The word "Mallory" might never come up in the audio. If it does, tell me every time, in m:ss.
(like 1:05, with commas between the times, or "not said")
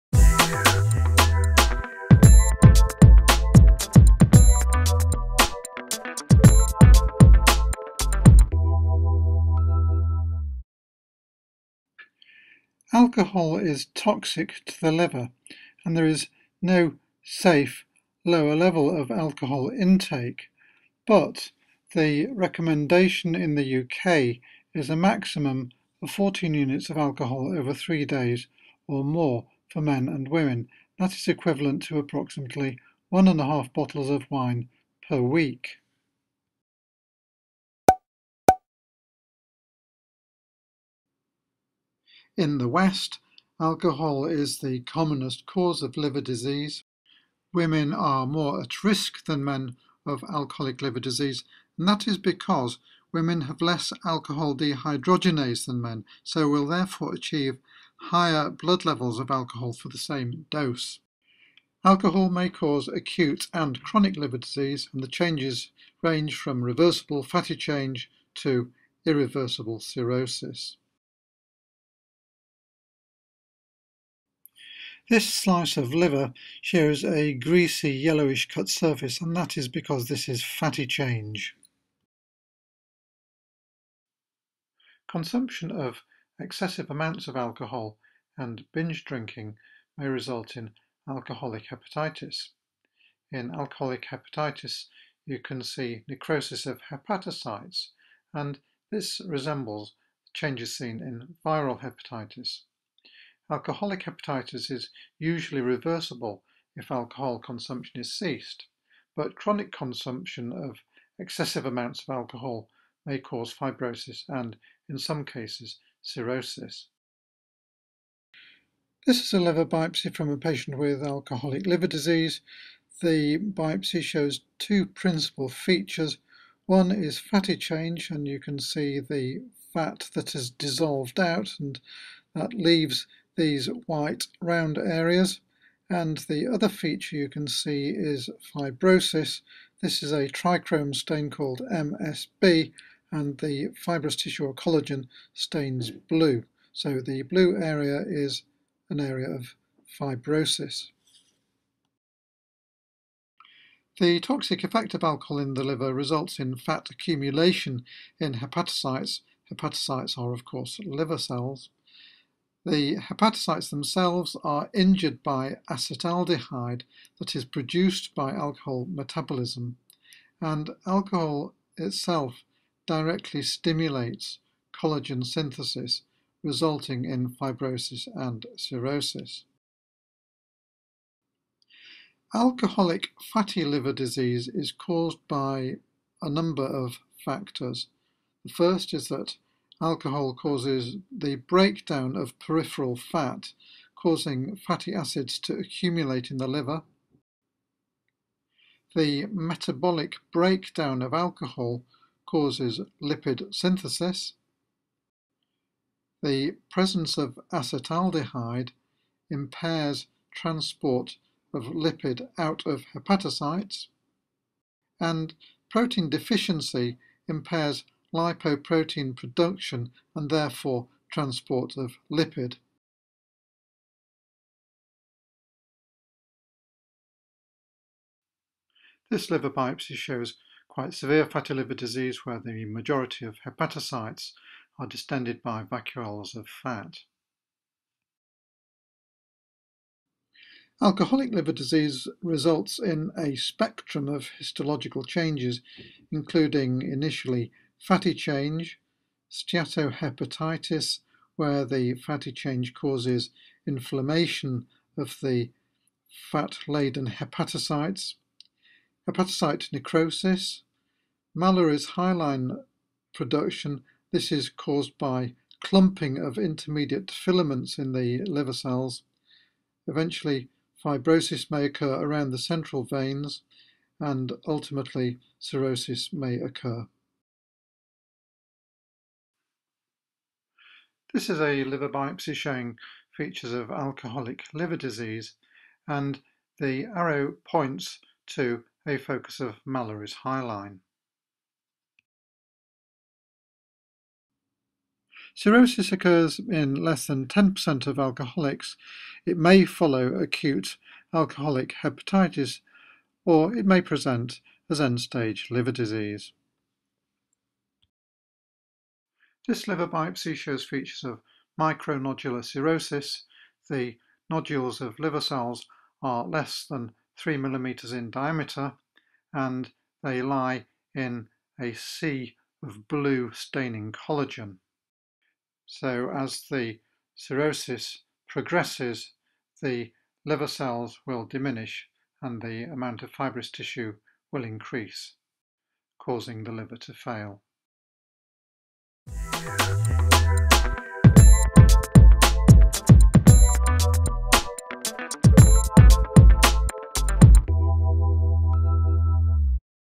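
4:21, 4:49.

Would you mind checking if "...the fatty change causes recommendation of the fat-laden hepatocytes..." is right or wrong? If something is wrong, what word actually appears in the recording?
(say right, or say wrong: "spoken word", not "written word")
wrong: "inflammation", not "recommendation".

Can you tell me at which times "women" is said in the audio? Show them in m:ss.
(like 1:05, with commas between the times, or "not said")
0:30, 0:47, 0:53.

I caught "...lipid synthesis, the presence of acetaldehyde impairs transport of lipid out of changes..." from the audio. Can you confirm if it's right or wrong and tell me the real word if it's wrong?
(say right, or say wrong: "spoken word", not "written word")
wrong: "hepatocytes", not "changes".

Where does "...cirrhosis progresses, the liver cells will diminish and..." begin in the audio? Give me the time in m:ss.
5:27.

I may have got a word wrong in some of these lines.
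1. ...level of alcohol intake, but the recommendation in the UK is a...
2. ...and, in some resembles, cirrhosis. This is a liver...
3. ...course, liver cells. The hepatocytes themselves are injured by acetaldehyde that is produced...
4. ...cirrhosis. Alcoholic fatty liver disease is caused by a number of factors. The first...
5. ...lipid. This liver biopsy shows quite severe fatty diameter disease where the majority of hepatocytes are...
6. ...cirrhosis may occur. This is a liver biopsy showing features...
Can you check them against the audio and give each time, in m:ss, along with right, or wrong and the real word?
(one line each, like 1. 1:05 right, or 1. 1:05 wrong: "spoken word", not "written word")
1. 0:18 right
2. 1:54 wrong: "cases", not "resembles"
3. 2:40 right
4. 2:58 right
5. 3:42 wrong: "liver", not "diameter"
6. 4:35 right.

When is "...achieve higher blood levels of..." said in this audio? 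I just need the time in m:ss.
0:57.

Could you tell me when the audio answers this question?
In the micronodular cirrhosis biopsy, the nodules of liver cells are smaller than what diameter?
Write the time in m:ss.
5:17.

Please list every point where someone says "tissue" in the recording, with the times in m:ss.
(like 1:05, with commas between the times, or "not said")
2:24, 5:33.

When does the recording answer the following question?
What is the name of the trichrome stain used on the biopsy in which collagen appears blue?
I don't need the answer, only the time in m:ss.
2:21.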